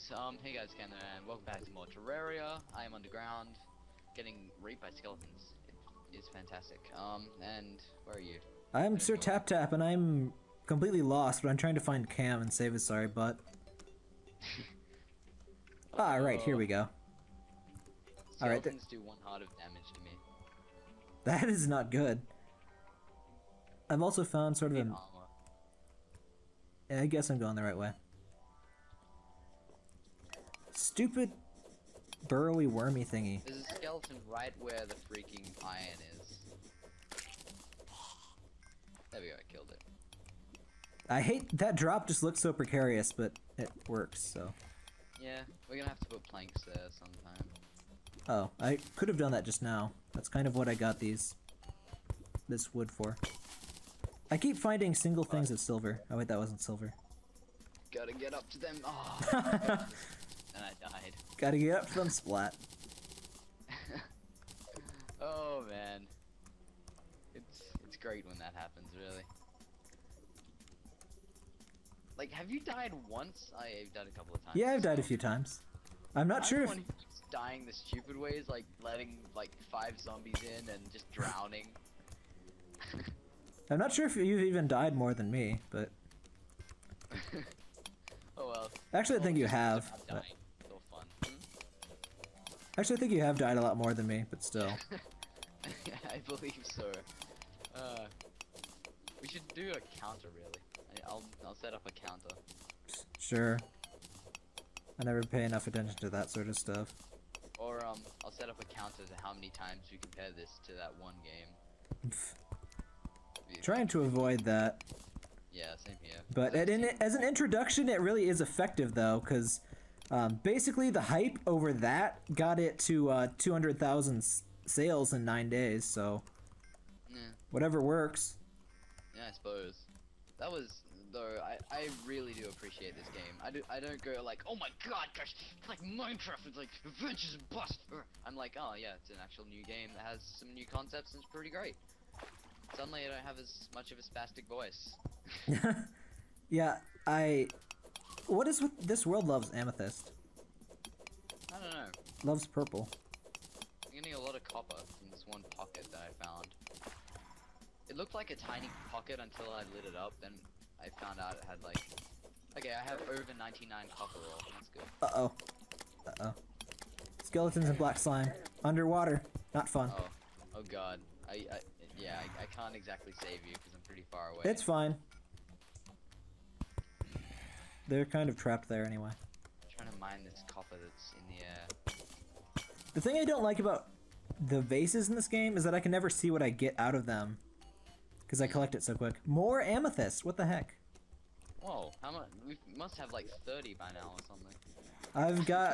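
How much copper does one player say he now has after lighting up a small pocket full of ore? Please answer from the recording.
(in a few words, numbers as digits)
Over 99.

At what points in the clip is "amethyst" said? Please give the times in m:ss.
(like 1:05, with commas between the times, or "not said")
2:29, 3:09.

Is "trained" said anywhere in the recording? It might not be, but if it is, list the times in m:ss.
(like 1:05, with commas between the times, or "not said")
not said.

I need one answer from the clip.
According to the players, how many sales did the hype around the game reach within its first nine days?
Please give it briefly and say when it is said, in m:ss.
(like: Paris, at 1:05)
200,000, at 2:03.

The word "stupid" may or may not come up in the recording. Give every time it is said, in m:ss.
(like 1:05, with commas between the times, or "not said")
0:30, 1:17.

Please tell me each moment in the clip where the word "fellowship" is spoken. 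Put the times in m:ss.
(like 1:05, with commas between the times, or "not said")
not said.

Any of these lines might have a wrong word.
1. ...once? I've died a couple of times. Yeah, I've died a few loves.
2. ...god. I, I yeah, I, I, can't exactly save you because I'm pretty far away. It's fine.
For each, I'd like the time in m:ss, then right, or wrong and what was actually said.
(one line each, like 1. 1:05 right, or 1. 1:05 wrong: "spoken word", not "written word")
1. 1:12 wrong: "times", not "loves"
2. 2:50 right.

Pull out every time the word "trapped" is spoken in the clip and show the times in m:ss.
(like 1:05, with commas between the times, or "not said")
2:58.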